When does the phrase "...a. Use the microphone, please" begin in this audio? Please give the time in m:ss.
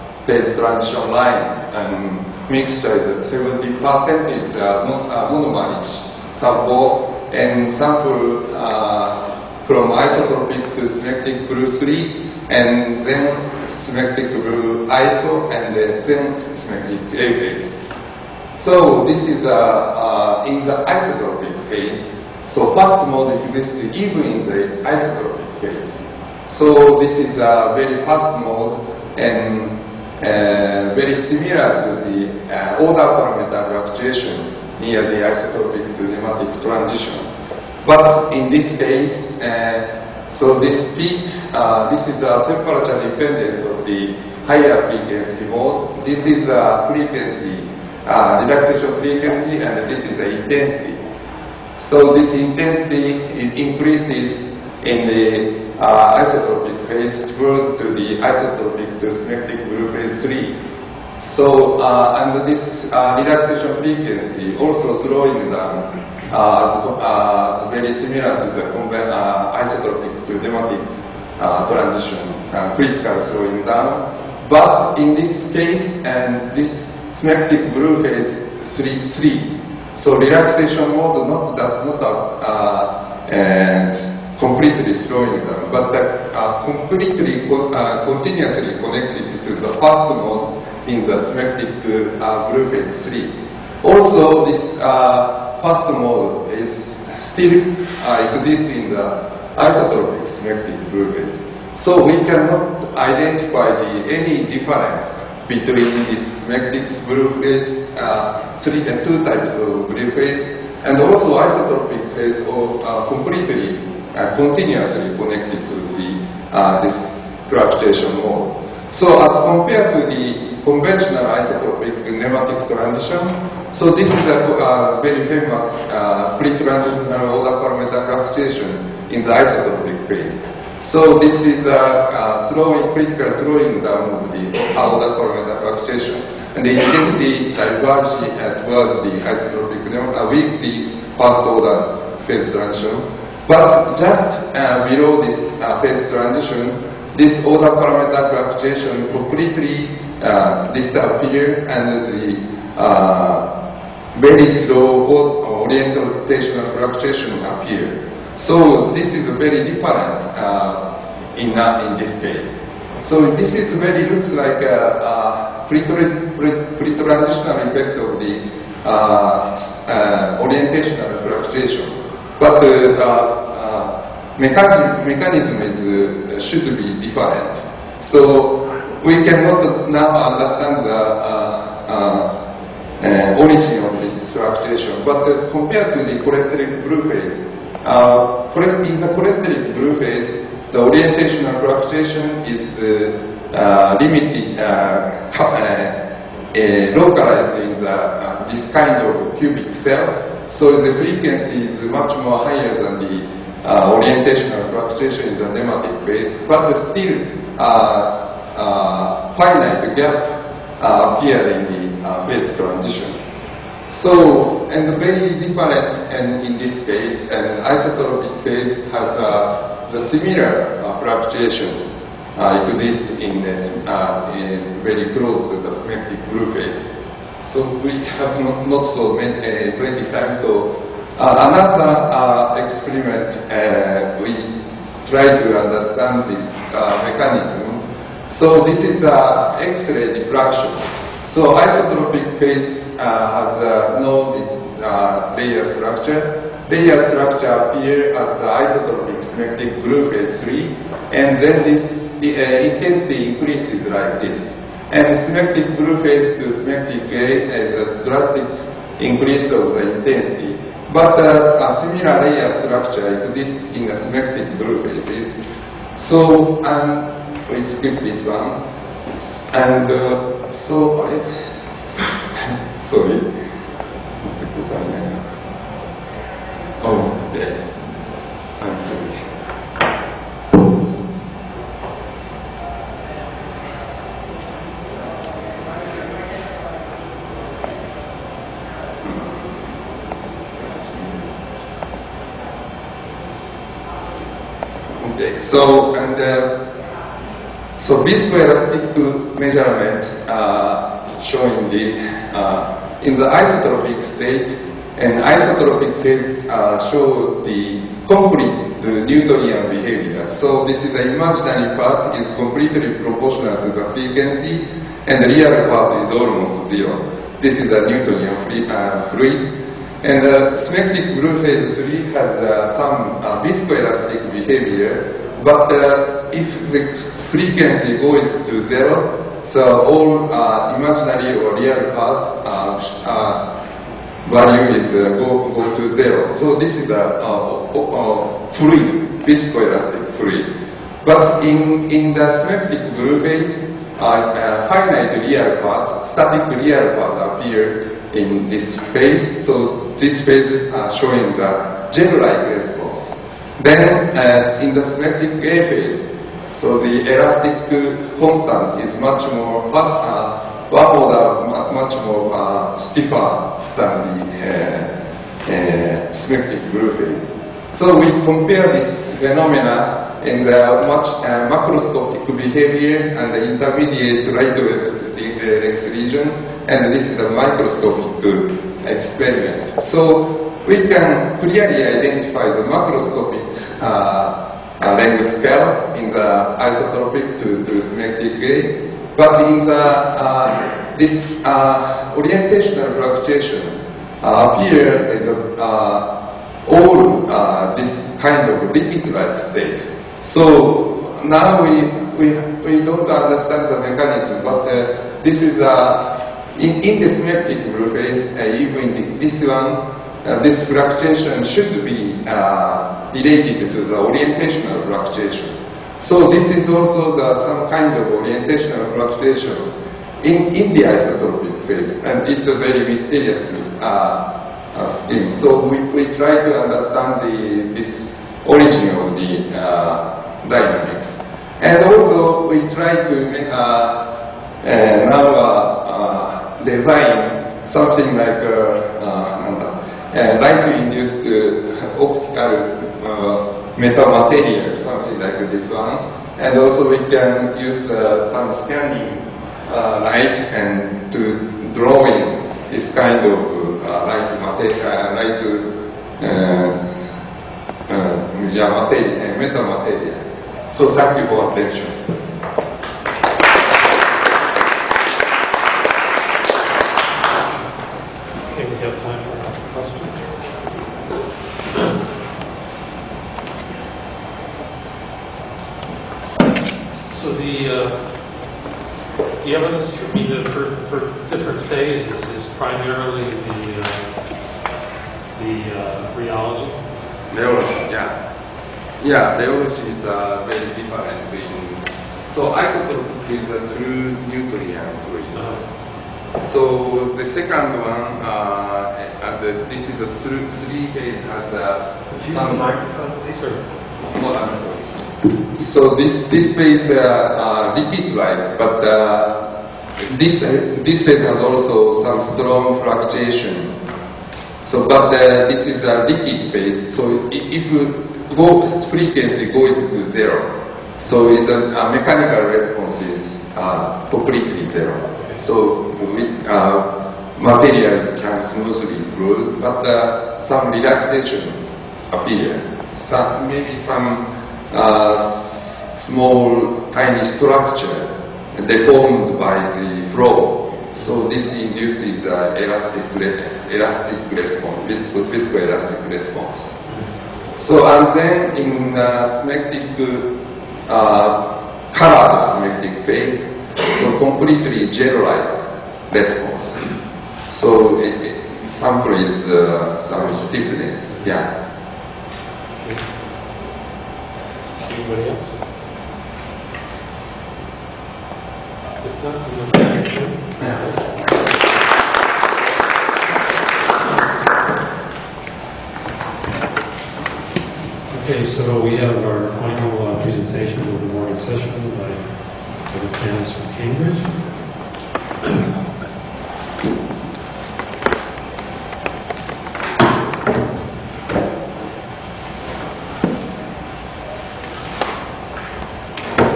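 8:21.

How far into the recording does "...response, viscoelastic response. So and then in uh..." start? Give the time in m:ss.
9:04.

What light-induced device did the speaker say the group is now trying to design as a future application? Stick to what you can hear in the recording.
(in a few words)
optical metamaterial.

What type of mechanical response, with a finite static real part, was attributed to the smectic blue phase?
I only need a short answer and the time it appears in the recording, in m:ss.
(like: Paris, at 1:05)
gel-like response, at 5:51.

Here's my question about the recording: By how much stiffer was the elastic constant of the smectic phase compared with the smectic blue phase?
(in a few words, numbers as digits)
one order.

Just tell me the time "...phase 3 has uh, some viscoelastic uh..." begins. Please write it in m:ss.
5:21.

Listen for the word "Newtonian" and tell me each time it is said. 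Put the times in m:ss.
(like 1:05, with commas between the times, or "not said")
5:09, 5:17.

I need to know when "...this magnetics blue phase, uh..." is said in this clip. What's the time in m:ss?
1:46.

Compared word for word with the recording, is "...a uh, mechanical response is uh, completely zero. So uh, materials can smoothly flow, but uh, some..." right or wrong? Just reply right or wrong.
right.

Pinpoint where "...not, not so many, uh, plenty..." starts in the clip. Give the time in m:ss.
3:48.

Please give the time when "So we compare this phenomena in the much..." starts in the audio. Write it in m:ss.
6:07.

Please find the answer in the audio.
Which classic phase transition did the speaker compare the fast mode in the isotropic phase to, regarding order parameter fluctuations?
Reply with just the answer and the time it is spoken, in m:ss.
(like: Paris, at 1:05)
isotropic to nematic, at 0:34.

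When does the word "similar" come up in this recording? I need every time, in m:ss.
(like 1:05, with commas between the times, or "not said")
0:31, 1:07, 3:39, 4:21.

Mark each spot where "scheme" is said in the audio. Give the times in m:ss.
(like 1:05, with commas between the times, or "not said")
7:05.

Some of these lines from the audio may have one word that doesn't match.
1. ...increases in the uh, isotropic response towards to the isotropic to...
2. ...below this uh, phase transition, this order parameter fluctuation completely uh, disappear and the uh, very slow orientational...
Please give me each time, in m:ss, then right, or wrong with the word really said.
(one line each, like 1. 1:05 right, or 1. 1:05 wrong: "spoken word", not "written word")
1. 0:53 wrong: "phase", not "response"
2. 2:24 right.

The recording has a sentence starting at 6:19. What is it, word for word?
So we can clearly identify the macroscopic uh, language scale in the isotropic to, to smectic degree.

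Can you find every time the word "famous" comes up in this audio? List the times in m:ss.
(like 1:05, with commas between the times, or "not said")
2:05.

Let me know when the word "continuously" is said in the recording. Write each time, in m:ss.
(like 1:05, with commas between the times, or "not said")
1:28, 1:54.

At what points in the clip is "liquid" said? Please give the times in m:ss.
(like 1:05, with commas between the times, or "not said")
6:38, 8:27, 8:36.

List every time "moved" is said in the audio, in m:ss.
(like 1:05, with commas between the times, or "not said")
not said.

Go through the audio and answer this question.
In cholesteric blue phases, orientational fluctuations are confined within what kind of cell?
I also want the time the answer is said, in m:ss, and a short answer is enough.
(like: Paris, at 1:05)
cubic cell, at 3:19.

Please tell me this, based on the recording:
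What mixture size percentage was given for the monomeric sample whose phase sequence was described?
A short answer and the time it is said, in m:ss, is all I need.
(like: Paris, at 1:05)
70%, at 0:03.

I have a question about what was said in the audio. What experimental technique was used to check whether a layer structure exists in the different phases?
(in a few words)
X-ray diffraction.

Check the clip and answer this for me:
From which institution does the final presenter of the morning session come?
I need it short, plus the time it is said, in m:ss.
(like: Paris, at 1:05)
Cambridge, at 9:43.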